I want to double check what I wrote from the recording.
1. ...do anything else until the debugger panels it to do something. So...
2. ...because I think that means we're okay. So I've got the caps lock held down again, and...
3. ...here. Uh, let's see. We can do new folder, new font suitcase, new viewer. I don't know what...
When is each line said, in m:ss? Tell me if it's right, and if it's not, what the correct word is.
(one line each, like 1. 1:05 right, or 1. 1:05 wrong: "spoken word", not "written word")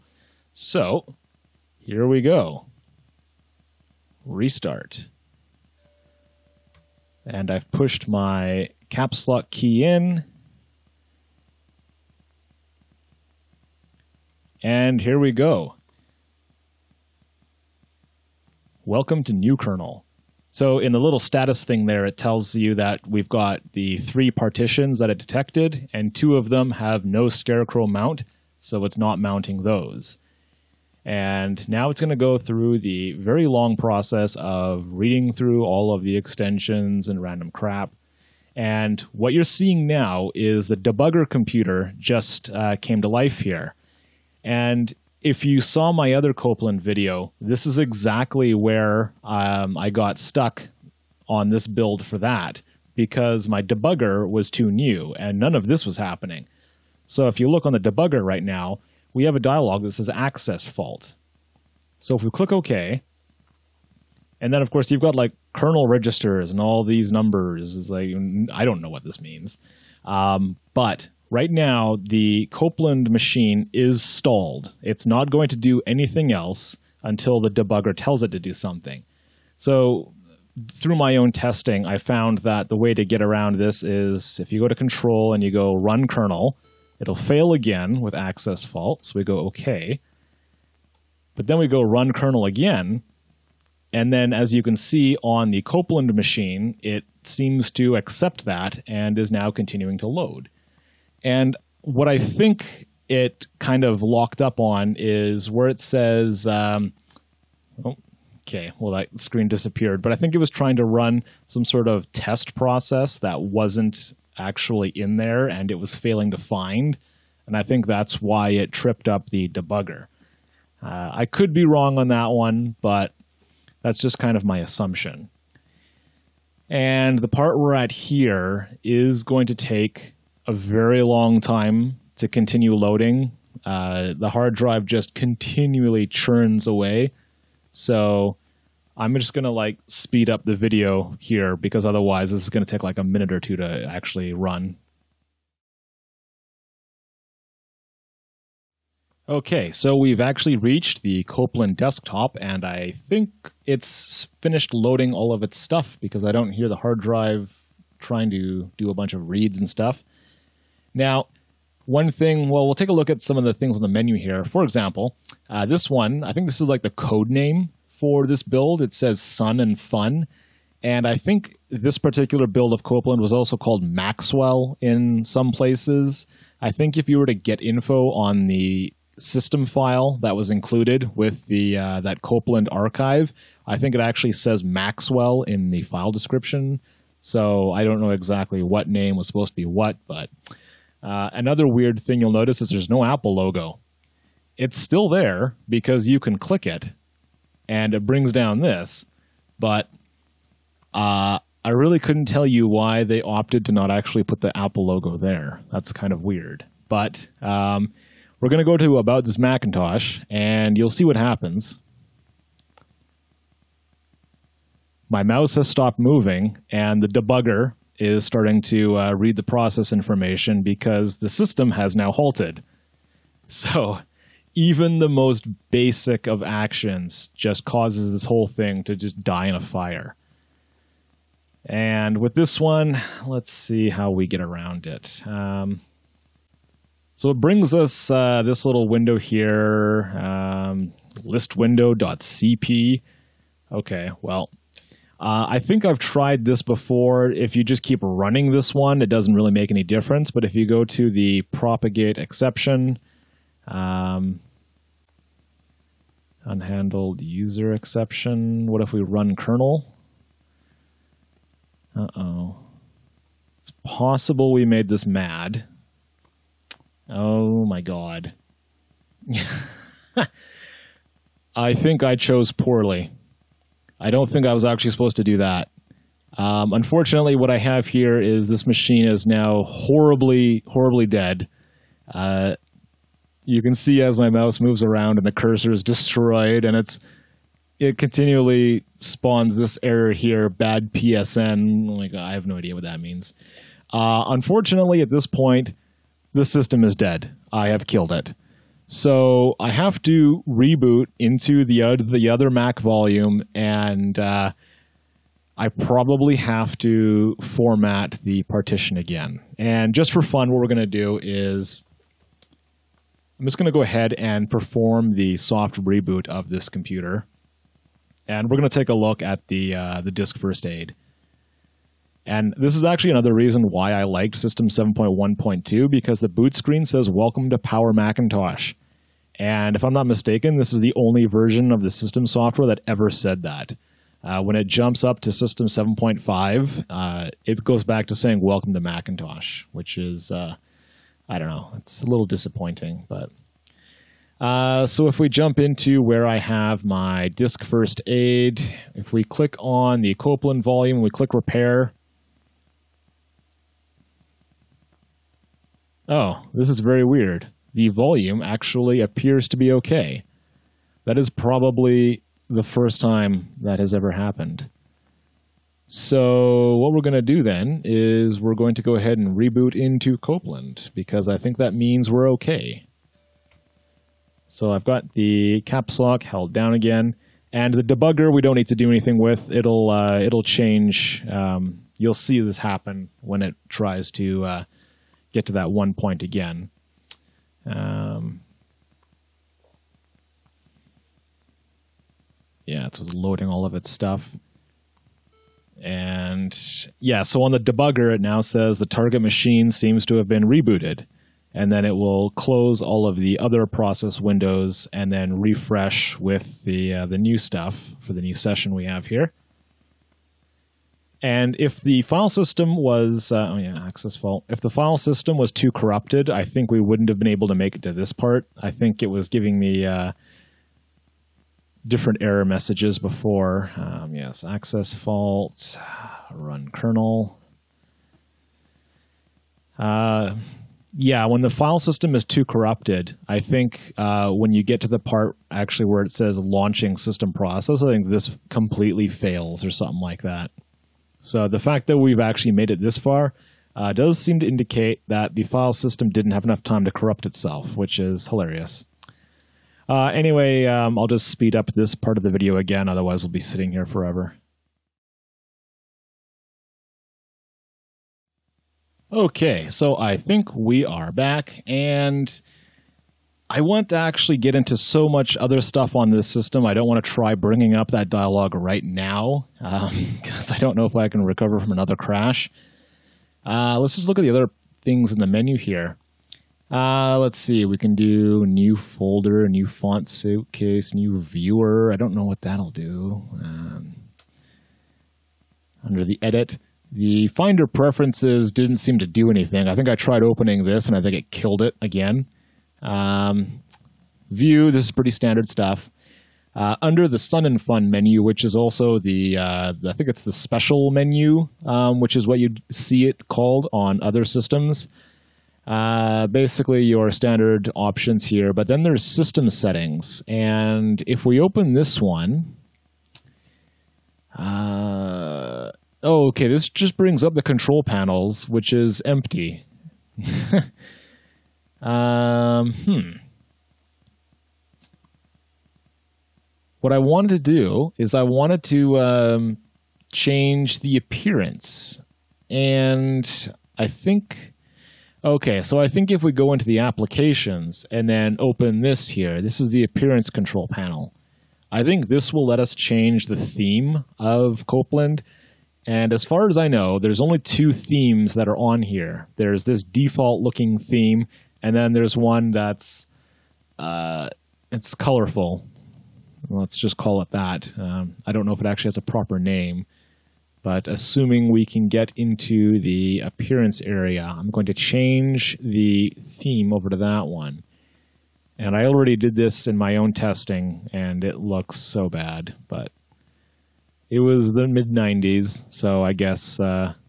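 1. 1:15 wrong: "tells", not "panels"
2. 6:10 right
3. 7:55 right.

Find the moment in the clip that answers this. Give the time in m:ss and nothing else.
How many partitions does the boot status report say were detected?
0:23.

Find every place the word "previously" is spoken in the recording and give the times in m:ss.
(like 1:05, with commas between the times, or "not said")
not said.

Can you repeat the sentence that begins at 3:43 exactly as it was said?
So even the most basic of actions just causes this whole thing to just die in a fire.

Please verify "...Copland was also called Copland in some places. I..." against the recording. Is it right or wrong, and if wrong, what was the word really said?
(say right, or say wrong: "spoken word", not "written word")
wrong: "Maxwell", not "Copland".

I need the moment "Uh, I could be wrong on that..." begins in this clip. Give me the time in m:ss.
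2:00.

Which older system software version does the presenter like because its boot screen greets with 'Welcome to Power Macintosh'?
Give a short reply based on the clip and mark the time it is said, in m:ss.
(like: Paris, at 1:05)
System 7.1.2, at 5:24.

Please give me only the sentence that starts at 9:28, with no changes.
And I already did this in my own testing, and it looks so bad.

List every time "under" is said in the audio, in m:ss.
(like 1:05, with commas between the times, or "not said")
8:05, 8:16.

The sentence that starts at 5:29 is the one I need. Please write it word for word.
And if I'm not mistaken, this is the only version of the system software that ever said that.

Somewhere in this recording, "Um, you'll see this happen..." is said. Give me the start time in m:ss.
6:21.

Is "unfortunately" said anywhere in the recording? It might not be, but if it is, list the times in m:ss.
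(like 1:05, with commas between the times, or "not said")
4:36, 4:54.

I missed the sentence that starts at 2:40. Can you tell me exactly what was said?
Now, one thing, well, we'll take a look at some of the things on the menu here.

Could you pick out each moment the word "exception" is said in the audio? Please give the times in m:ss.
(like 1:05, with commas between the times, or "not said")
4:12, 4:17.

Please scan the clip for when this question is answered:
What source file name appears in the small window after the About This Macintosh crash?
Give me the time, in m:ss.
4:01.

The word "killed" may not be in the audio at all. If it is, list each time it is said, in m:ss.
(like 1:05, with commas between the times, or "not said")
4:57, 8:11.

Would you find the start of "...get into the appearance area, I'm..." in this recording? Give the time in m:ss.
9:21.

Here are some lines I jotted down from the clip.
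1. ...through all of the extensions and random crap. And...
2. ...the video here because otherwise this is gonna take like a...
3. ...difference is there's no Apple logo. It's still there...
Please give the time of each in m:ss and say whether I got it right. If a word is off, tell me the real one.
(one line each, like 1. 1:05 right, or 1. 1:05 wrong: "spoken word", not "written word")
1. 0:35 right
2. 2:20 right
3. 3:12 wrong: "notice", not "difference".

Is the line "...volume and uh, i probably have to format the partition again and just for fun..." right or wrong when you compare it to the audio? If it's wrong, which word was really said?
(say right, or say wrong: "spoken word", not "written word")
right.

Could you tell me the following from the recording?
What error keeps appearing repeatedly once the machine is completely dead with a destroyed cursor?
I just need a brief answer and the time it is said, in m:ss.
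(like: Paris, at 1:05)
bad psn, at 4:50.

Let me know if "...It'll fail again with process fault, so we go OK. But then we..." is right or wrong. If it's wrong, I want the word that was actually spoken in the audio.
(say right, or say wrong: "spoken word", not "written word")
wrong: "access", not "process".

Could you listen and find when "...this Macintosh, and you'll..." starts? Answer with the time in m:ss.
3:29.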